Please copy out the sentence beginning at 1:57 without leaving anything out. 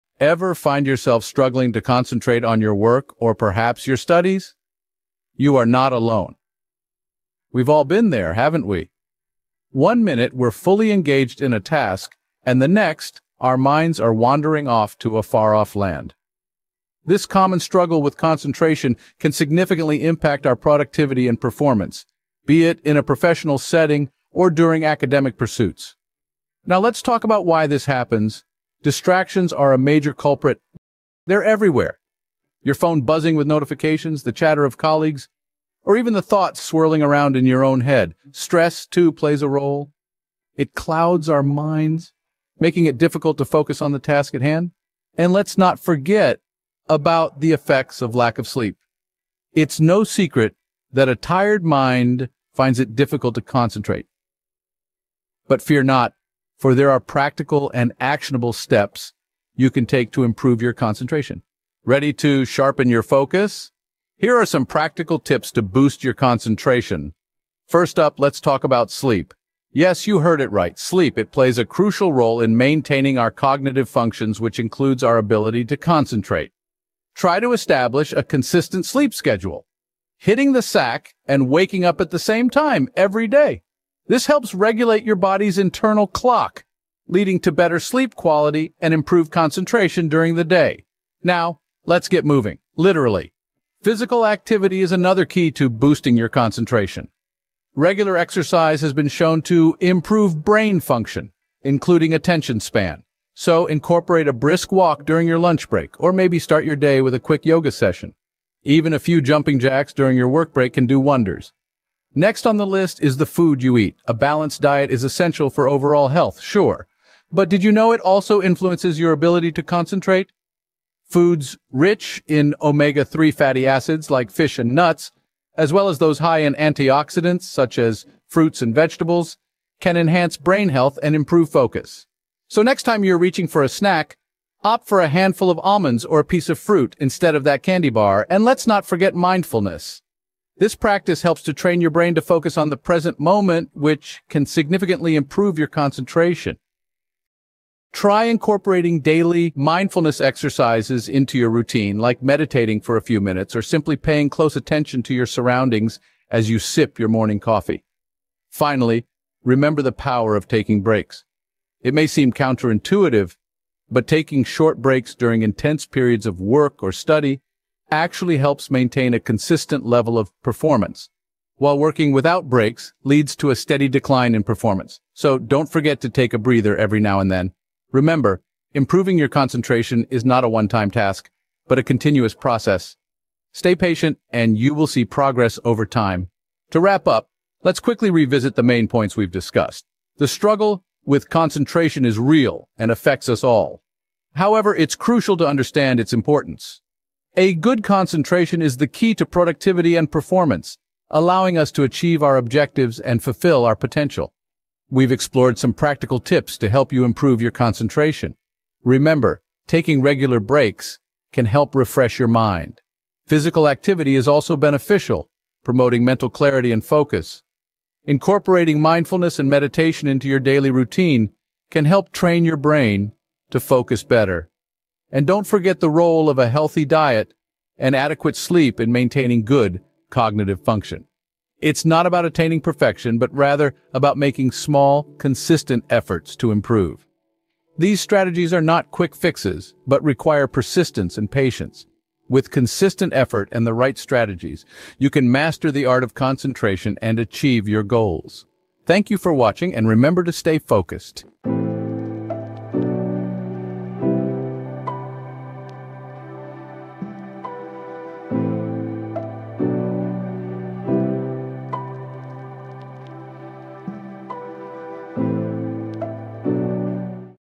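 But did you know it also influences your ability to concentrate?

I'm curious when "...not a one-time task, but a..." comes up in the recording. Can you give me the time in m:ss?
3:00.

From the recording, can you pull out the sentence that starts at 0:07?
We've all been there, haven't we?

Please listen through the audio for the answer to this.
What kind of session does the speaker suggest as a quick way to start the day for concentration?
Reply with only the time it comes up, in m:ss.
1:47.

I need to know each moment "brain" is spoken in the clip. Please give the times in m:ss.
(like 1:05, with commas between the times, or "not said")
1:40, 2:10, 2:21, 3:42.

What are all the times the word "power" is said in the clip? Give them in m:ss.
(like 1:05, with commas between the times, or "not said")
2:39.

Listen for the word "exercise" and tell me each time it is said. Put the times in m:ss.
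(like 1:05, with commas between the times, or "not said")
1:38, 2:30.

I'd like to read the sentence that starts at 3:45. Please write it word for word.
And don't forget the role of a healthy diet and adequate sleep in maintaining good cognitive function.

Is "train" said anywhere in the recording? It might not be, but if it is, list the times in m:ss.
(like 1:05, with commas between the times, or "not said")
2:21, 3:42.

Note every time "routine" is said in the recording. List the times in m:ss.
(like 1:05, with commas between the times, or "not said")
2:31, 3:40.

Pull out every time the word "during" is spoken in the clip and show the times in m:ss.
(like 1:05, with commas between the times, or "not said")
0:24, 1:30, 1:45, 1:49, 2:45.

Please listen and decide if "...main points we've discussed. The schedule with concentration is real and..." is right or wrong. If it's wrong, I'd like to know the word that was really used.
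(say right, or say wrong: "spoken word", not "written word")
wrong: "struggle", not "schedule".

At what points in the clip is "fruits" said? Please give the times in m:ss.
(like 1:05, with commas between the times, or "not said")
2:08, 2:16.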